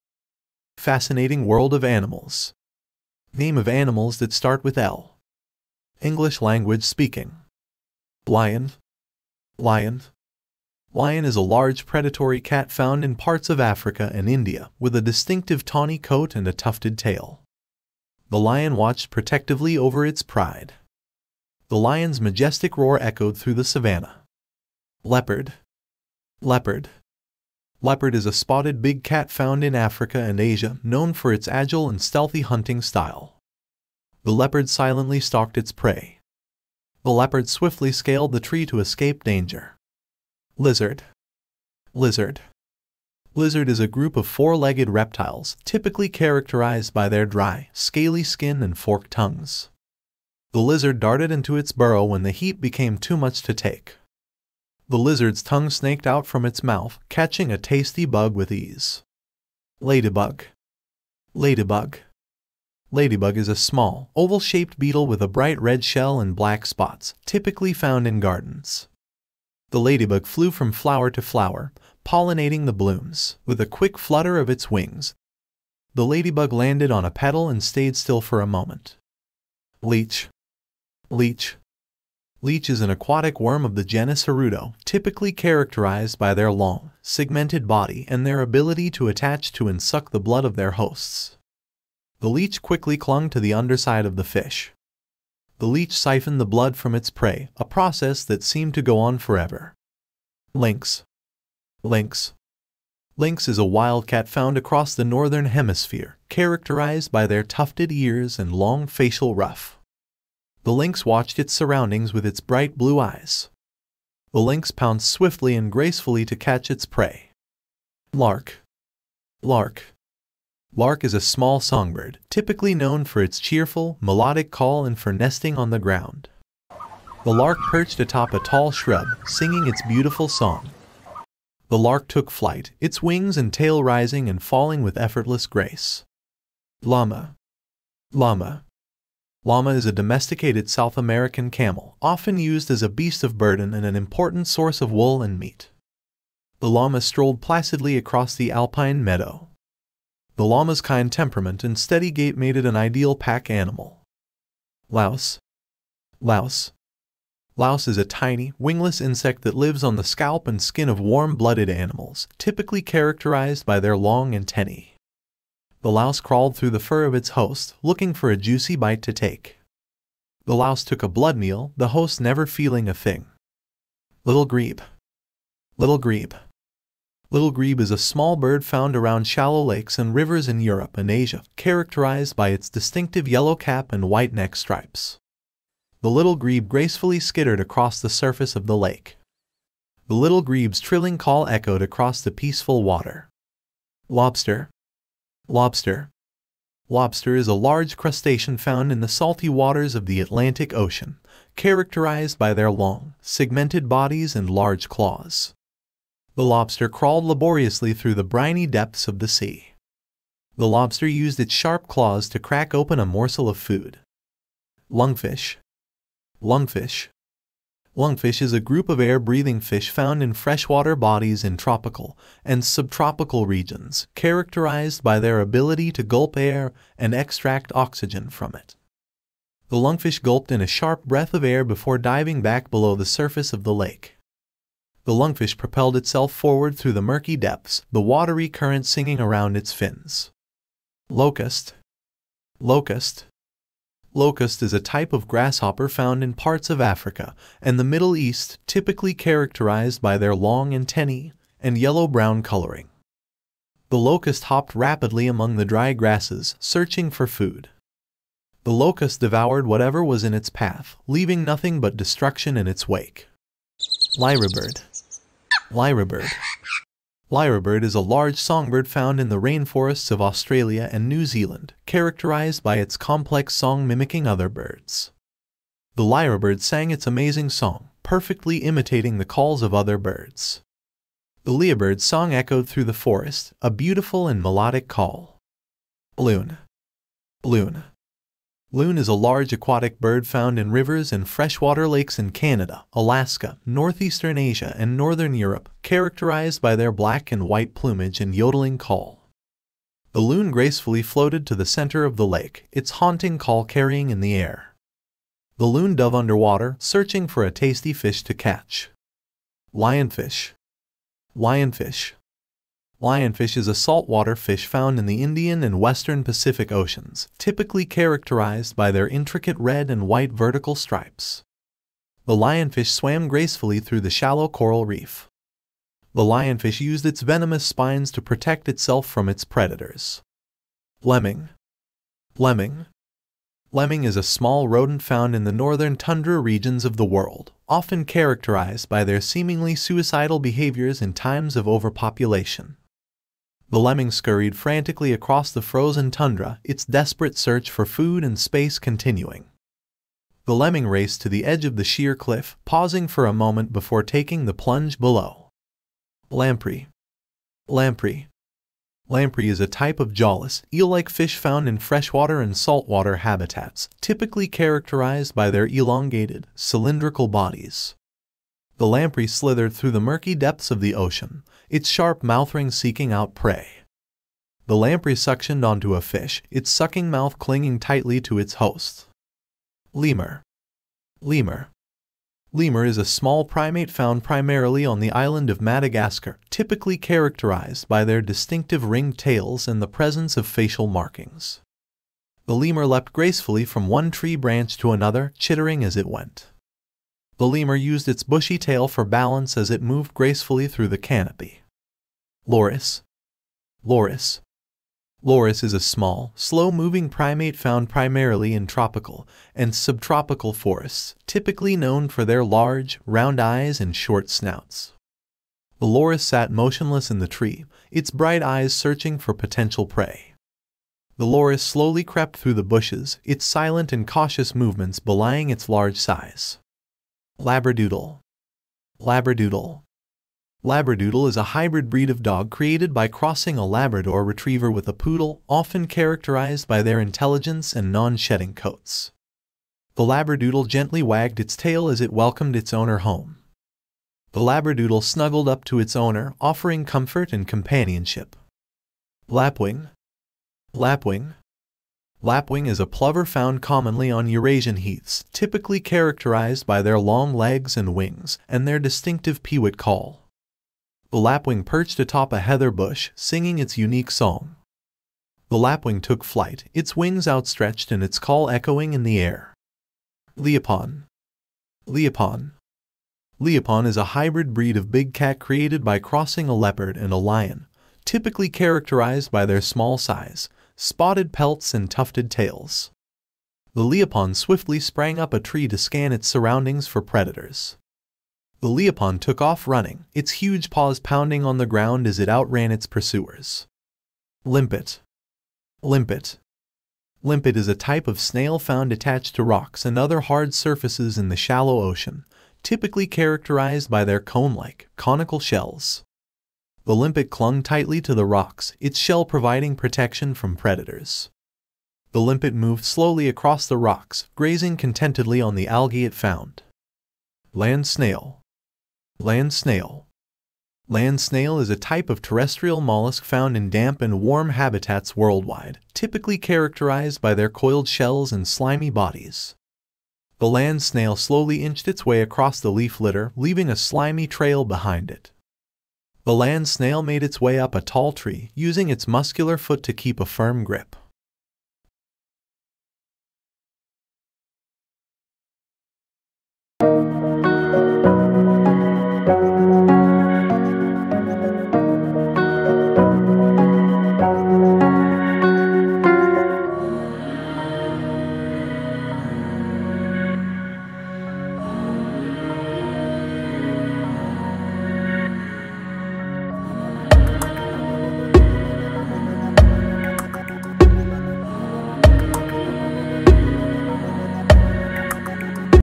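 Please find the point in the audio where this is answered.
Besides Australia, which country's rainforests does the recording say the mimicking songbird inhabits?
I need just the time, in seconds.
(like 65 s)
271 s.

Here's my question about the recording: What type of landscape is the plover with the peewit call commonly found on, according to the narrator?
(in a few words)
Eurasian heaths.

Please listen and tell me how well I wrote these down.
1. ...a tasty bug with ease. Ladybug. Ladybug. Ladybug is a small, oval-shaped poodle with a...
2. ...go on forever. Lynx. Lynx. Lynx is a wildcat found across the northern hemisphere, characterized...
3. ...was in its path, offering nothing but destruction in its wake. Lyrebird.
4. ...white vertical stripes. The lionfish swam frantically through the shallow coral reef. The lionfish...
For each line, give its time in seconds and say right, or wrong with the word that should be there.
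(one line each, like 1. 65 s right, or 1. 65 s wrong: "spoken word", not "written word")
1. 57 s wrong: "beetle", not "poodle"
2. 98 s right
3. 260 s wrong: "leaving", not "offering"
4. 320 s wrong: "gracefully", not "frantically".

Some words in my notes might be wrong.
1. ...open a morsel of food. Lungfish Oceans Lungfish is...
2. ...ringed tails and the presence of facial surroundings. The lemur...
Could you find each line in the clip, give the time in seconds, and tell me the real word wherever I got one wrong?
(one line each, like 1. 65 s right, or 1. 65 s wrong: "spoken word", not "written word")
1. 212 s wrong: "Lungfish", not "Oceans"
2. 388 s wrong: "markings", not "surroundings".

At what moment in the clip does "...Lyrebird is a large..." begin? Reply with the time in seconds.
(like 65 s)
267 s.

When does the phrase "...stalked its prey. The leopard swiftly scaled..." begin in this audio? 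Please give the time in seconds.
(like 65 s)
35 s.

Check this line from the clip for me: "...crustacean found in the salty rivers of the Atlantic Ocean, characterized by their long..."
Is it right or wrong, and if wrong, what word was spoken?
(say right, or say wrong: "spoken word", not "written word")
wrong: "waters", not "rivers".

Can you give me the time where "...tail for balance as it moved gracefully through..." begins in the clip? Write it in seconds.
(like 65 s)
398 s.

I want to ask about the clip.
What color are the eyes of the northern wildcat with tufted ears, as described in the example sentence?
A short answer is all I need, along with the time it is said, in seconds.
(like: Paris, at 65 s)
Bright blue, at 112 s.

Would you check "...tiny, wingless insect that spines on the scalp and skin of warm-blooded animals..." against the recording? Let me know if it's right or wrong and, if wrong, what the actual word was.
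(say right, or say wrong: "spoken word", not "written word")
wrong: "lives", not "spines".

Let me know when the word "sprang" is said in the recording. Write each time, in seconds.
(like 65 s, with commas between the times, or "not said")
484 s.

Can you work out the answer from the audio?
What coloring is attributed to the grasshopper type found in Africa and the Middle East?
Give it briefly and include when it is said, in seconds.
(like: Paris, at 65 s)
Yellow-brown, at 251 s.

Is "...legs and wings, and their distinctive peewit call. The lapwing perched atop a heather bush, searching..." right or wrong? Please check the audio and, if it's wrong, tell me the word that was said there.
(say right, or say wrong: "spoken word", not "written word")
wrong: "singing", not "searching".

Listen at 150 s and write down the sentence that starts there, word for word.
The llama's kind temperament and steady gait made it an ideal pack animal.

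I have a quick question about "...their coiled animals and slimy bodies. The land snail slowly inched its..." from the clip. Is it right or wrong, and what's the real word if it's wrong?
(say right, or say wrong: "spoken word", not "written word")
wrong: "shells", not "animals".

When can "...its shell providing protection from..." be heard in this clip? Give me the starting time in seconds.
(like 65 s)
508 s.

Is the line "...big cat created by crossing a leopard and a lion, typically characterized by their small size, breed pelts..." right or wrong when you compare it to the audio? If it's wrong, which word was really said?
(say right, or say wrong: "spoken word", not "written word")
wrong: "spotted", not "breed".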